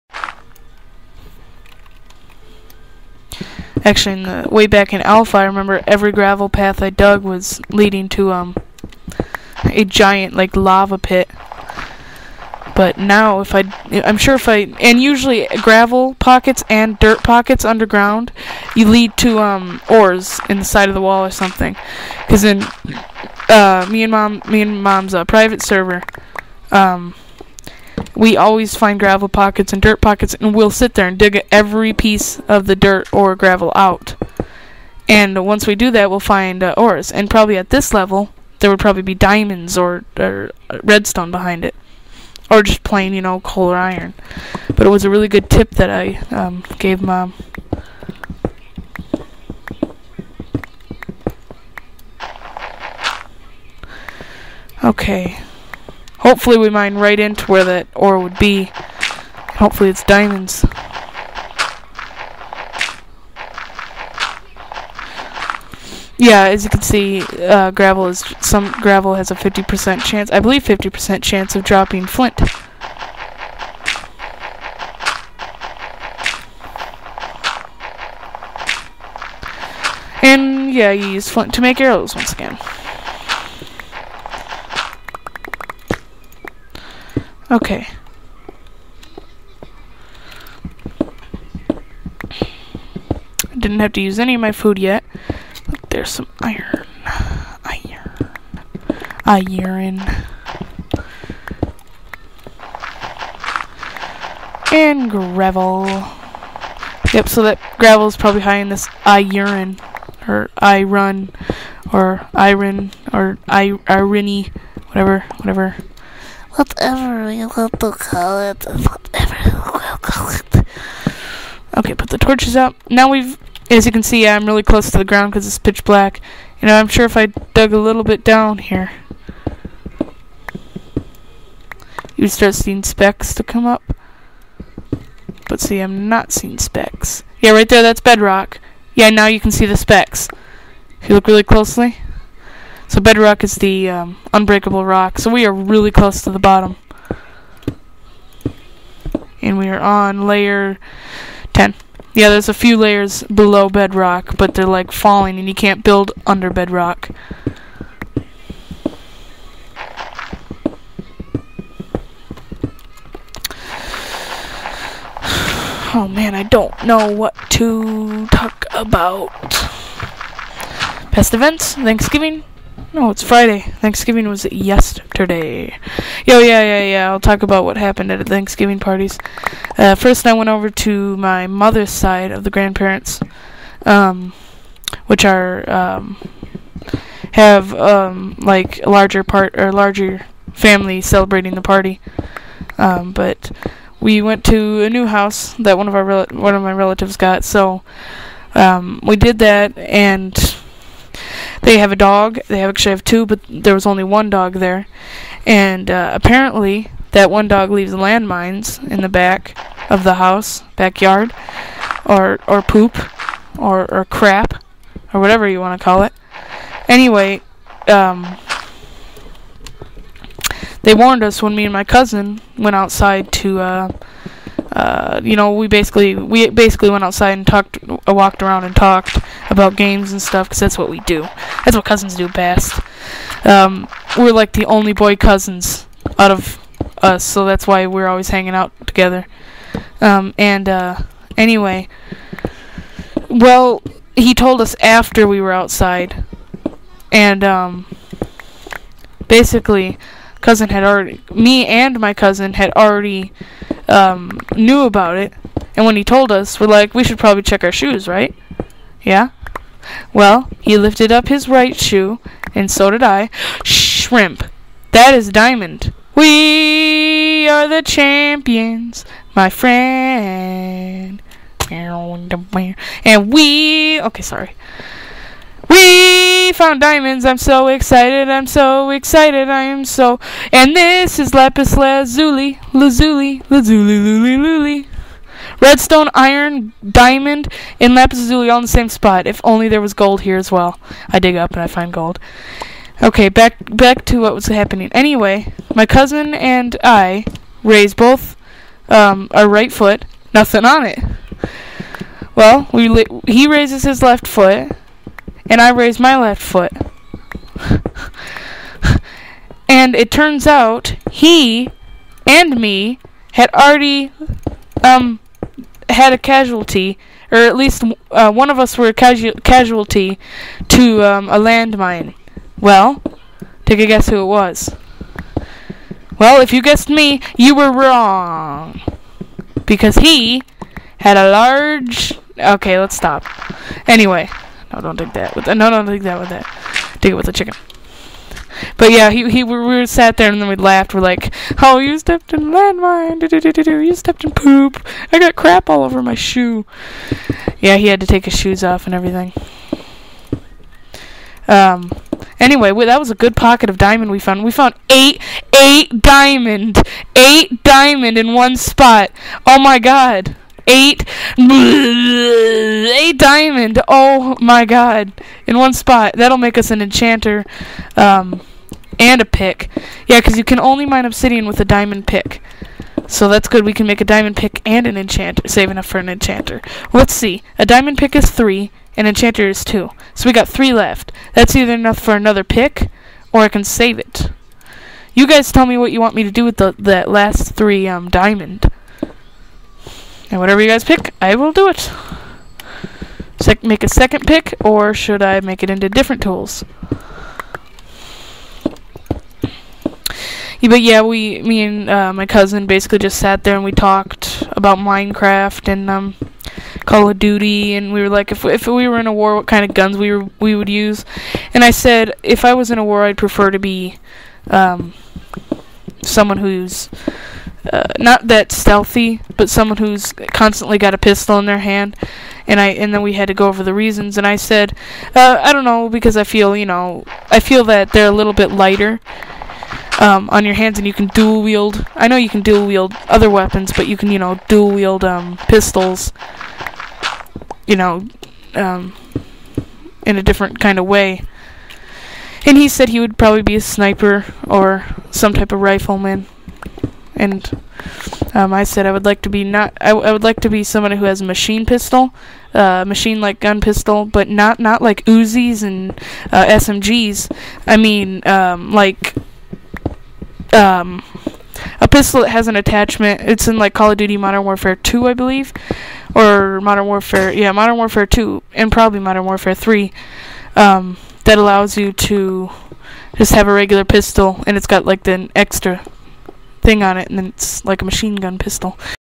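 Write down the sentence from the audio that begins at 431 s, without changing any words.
I know you can dual wield other weapons, but you can you know dual wield um, pistols.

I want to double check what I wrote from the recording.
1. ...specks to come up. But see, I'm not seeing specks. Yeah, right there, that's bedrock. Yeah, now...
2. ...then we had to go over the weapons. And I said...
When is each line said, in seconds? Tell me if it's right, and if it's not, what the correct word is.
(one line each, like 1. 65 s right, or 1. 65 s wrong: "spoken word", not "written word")
1. 132 s right
2. 422 s wrong: "reasons", not "weapons".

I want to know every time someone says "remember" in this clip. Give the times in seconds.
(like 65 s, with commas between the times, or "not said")
5 s.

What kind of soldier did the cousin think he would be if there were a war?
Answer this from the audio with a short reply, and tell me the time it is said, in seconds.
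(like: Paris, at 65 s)
A sniper, at 443 s.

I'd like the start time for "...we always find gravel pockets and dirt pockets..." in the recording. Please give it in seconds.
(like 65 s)
28 s.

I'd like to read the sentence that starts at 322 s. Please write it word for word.
Well, take a guess who it was.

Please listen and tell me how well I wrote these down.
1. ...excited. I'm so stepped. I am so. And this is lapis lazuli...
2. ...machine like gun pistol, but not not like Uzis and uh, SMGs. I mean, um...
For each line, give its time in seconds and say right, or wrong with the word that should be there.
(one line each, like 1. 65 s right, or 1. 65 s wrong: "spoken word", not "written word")
1. 277 s wrong: "excited", not "stepped"
2. 452 s right.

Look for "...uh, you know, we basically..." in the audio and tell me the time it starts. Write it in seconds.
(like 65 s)
224 s.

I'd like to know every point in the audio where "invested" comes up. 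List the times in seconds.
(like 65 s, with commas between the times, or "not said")
not said.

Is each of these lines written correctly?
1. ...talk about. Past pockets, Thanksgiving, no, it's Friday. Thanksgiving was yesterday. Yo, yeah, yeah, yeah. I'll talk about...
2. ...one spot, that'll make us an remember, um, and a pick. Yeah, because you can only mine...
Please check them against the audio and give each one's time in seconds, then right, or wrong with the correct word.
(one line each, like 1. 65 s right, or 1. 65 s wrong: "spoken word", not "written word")
1. 168 s wrong: "events", not "pockets"
2. 365 s wrong: "enchanter", not "remember".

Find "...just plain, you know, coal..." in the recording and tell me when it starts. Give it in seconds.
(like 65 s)
42 s.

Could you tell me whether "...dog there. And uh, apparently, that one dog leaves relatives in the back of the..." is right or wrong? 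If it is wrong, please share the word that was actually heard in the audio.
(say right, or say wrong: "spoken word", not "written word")
wrong: "landmines", not "relatives".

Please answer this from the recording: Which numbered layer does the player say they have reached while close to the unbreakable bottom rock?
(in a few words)
10.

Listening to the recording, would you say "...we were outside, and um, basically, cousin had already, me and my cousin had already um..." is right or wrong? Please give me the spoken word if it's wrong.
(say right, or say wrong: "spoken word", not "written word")
right.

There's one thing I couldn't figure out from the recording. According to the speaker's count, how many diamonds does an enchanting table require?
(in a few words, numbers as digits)
2.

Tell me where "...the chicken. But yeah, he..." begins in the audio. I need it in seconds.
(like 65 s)
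337 s.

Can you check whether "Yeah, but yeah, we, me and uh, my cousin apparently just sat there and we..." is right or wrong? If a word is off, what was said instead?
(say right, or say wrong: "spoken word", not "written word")
wrong: "basically", not "apparently".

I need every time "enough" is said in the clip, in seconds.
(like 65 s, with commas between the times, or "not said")
375 s, 381 s.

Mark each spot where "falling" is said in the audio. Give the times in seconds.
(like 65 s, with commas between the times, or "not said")
154 s.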